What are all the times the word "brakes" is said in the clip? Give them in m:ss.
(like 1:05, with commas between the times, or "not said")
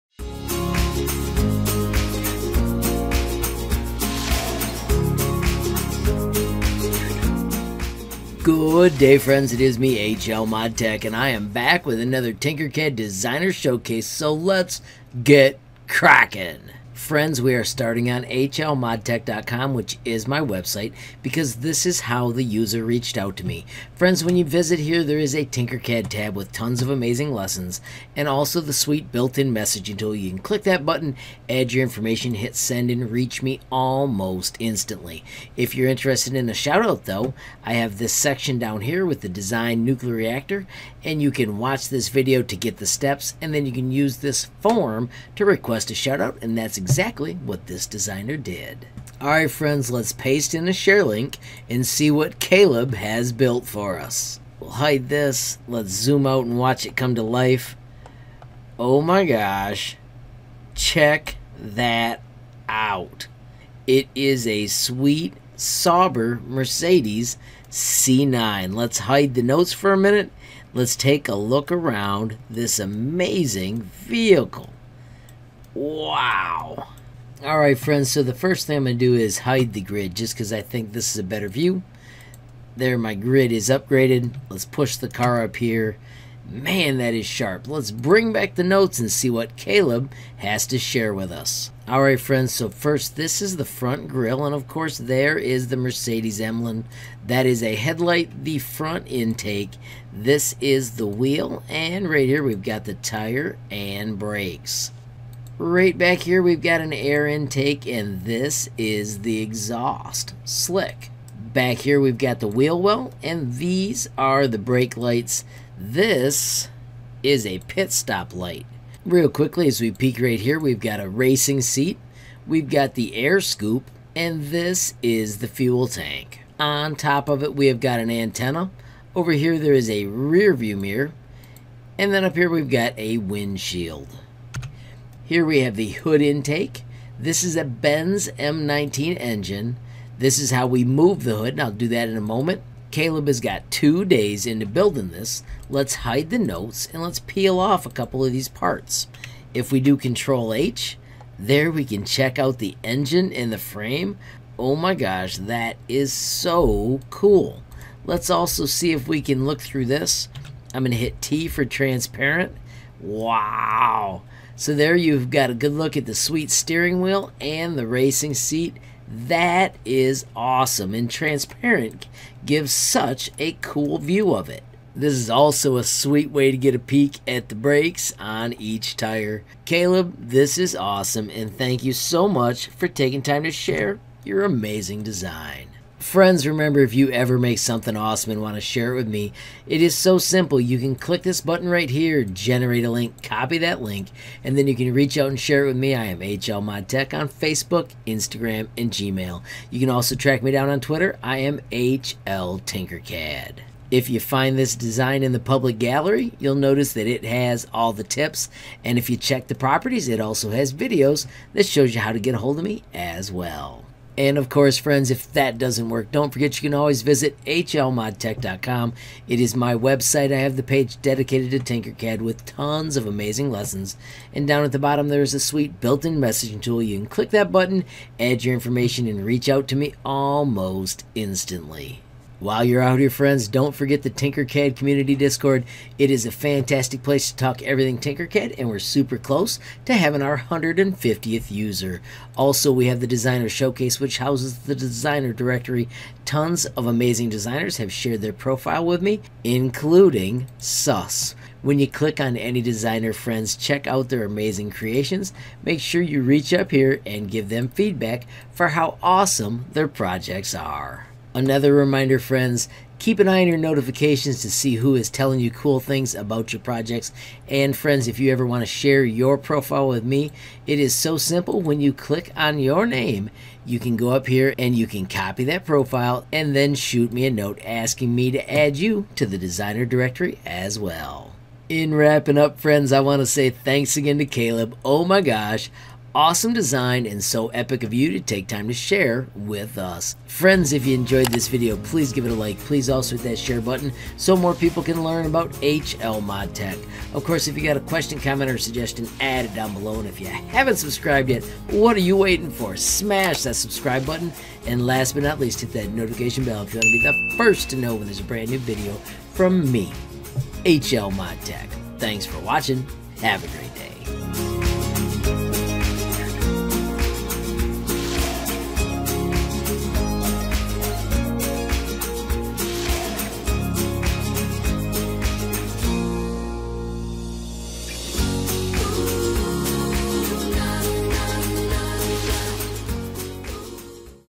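1:44, 1:54, 2:57.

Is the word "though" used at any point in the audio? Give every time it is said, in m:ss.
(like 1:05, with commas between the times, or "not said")
0:37.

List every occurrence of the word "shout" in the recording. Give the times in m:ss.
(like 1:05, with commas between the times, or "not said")
0:36, 0:45.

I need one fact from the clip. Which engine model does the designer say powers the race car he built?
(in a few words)
Benz M19.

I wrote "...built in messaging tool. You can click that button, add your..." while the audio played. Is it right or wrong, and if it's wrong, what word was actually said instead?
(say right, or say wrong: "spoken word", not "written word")
right.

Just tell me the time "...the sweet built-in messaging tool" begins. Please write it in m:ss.
0:28.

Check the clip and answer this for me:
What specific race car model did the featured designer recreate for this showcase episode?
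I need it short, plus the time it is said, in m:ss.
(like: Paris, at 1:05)
Sauber Mercedes C9, at 1:05.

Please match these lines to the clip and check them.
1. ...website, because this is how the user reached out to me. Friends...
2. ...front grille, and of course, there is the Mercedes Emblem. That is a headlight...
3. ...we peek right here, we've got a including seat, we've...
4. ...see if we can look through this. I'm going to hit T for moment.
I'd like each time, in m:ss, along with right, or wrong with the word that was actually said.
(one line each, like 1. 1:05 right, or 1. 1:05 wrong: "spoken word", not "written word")
1. 0:20 right
2. 1:33 right
3. 1:59 wrong: "racing", not "including"
4. 2:38 wrong: "transparent", not "moment".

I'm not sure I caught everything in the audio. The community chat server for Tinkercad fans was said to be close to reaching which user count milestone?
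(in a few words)
150th.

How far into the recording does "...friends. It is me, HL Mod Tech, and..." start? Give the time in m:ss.
0:09.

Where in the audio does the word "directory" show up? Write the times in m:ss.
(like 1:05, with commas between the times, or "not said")
4:05, 4:39.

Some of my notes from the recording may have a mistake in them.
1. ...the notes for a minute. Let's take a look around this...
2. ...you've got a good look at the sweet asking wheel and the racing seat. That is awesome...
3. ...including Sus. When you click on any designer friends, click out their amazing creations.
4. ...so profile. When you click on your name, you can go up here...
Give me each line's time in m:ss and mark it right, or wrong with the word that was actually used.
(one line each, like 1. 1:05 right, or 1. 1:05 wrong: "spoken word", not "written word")
1. 1:09 right
2. 2:44 wrong: "steering", not "asking"
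3. 4:09 wrong: "check", not "click"
4. 4:30 wrong: "simple", not "profile".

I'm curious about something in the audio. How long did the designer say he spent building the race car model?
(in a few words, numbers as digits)
2 days.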